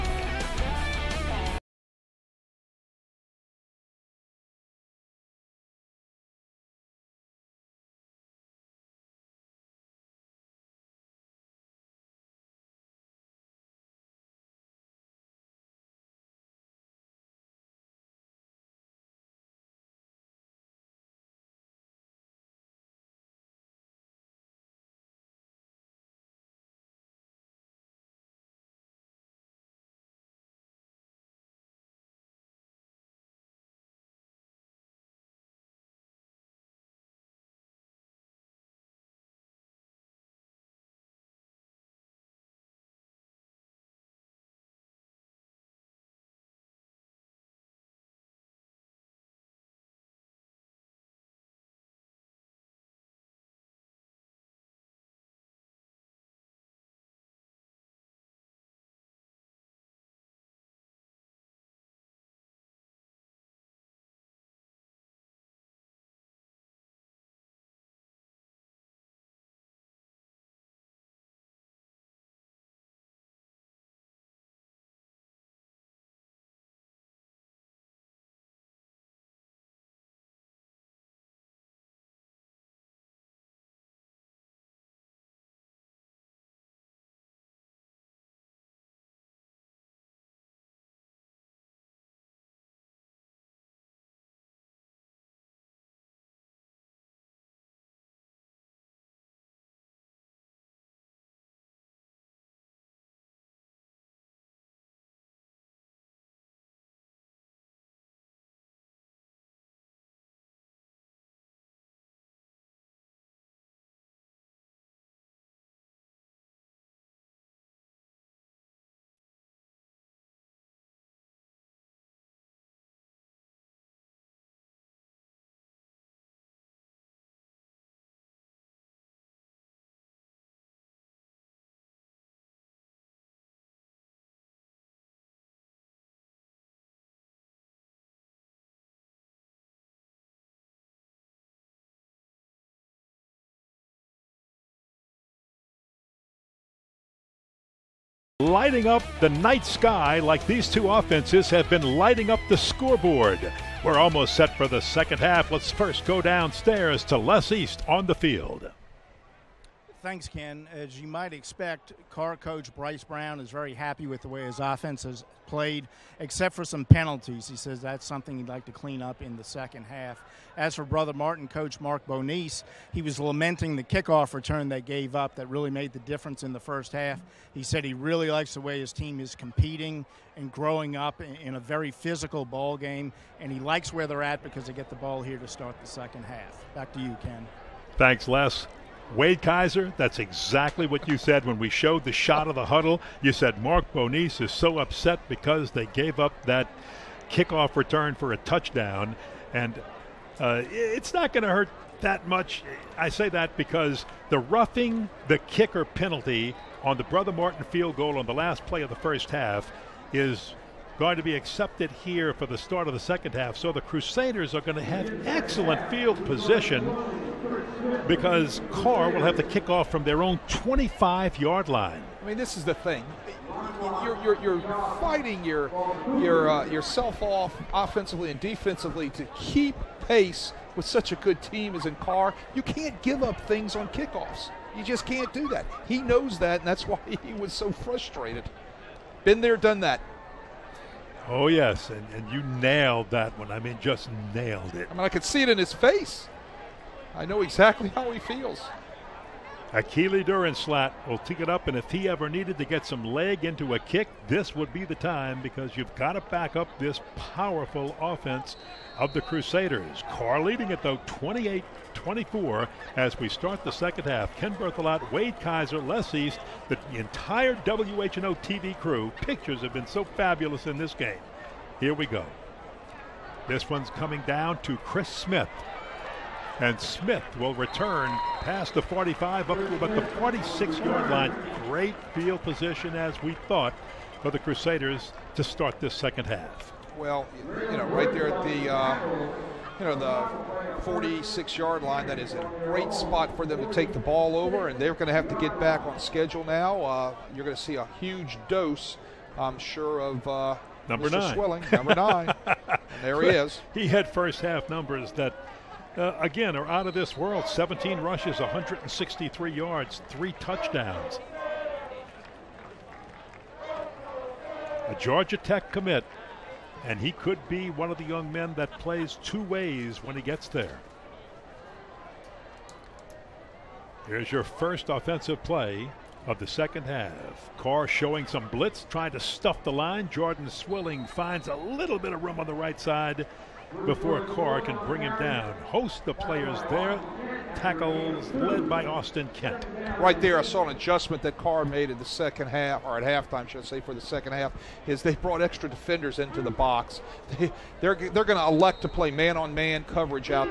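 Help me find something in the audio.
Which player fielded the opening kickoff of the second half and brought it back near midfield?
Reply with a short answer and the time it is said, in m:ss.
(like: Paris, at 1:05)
Chris Smith, at 4:34.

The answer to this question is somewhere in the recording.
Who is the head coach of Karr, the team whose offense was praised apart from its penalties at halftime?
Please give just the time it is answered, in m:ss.
2:42.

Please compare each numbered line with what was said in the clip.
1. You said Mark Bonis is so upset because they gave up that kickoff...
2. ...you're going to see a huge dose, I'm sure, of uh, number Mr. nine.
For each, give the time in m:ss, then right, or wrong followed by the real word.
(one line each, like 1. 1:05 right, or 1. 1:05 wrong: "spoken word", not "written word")
1. 3:13 right
2. 4:57 right.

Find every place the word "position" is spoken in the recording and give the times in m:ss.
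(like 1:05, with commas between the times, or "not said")
3:36, 4:42.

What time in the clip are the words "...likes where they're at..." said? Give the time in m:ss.
3:03.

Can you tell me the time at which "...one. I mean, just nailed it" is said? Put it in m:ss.
4:03.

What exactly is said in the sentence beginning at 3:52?
You can't give up things on kickoffs.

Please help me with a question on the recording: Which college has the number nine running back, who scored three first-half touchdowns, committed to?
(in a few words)
Georgia Tech.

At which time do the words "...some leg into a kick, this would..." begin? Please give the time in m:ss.
4:12.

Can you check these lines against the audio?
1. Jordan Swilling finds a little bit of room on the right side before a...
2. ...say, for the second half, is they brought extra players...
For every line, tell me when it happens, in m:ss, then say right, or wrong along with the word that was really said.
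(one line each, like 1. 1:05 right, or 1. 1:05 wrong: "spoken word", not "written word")
1. 5:30 right
2. 5:43 wrong: "defenders", not "players".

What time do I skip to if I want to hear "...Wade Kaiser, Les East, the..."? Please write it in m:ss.
4:25.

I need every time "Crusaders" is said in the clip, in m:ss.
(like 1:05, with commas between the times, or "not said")
3:33, 4:19, 4:44.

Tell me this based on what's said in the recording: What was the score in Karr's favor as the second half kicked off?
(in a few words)
28-24.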